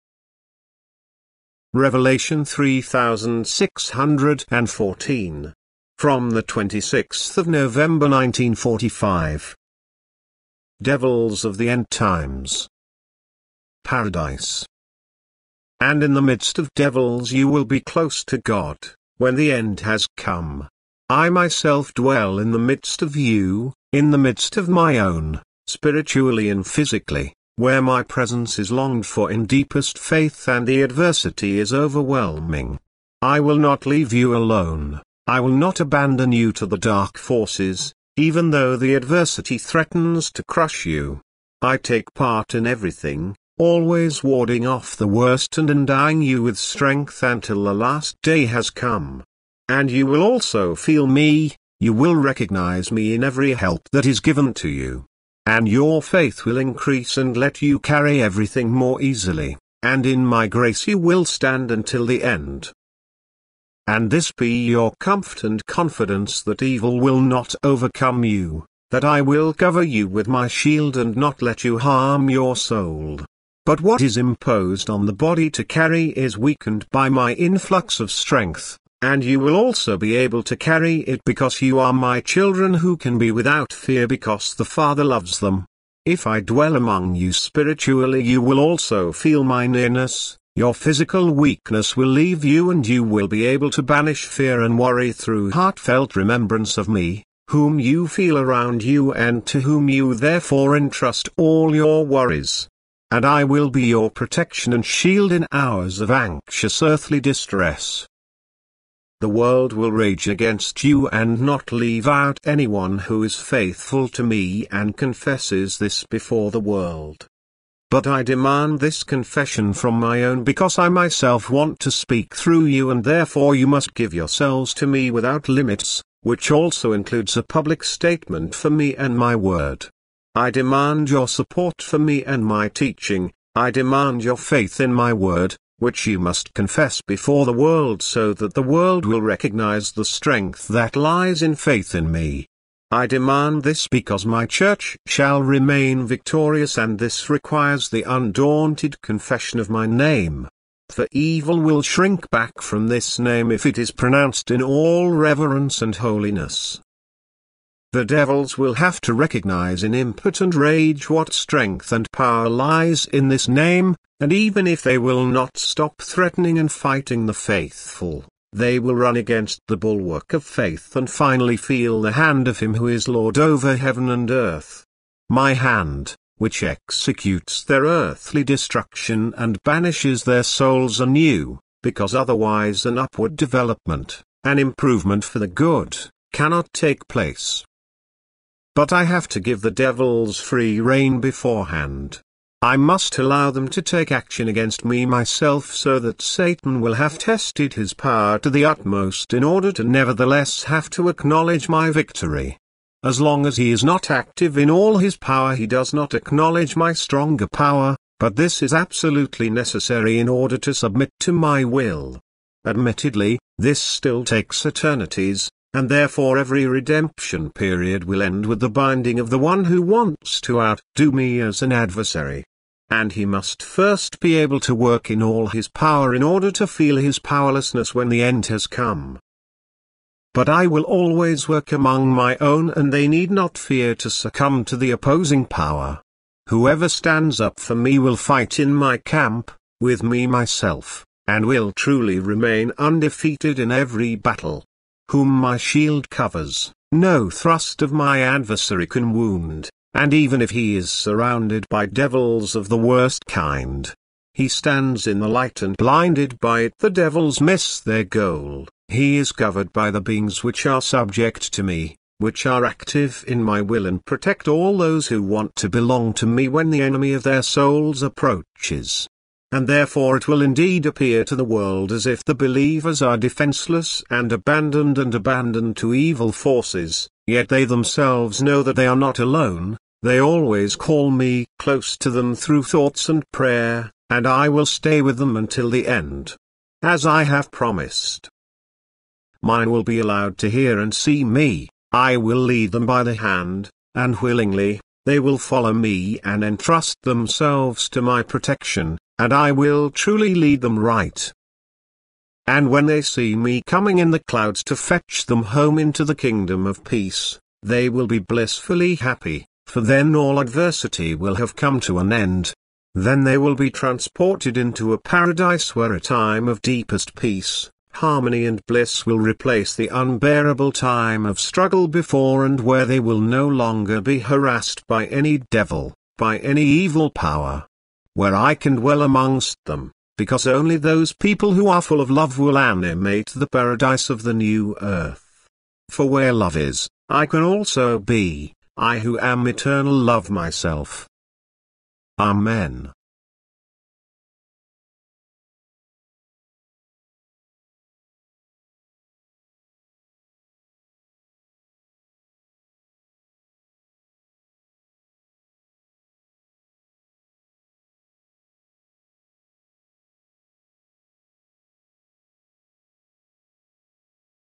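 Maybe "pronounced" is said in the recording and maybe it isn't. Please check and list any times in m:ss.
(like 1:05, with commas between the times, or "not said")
2:33.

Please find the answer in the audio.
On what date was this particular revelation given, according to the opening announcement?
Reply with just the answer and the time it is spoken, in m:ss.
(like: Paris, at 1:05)
26 November 1945, at 0:06.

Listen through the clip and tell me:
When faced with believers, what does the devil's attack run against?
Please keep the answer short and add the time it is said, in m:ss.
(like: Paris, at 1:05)
the bulwark of faith, at 2:49.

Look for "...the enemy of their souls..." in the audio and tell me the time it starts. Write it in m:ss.
4:26.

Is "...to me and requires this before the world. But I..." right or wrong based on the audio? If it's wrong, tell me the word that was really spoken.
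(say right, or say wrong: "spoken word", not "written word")
wrong: "confesses", not "requires".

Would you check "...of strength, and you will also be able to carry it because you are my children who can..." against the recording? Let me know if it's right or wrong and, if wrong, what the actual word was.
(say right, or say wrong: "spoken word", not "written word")
right.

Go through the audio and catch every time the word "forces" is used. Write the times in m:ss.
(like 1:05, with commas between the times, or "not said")
0:37, 4:36.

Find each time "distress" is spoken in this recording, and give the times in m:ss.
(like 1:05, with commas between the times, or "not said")
1:47.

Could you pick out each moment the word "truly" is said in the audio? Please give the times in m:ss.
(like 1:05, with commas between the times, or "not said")
4:01, 4:59.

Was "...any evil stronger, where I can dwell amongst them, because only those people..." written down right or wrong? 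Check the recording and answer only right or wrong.
wrong.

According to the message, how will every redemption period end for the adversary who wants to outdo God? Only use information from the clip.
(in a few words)
the binding.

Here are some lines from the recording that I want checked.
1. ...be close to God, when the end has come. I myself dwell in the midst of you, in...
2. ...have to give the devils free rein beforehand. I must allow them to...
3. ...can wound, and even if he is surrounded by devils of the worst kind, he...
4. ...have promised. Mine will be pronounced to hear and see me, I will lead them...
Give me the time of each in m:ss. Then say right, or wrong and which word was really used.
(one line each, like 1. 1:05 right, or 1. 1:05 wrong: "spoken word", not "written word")
1. 0:17 right
2. 3:09 right
3. 4:08 right
4. 4:47 wrong: "allowed", not "pronounced".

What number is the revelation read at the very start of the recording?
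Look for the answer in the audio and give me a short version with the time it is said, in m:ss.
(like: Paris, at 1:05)
3614, at 0:02.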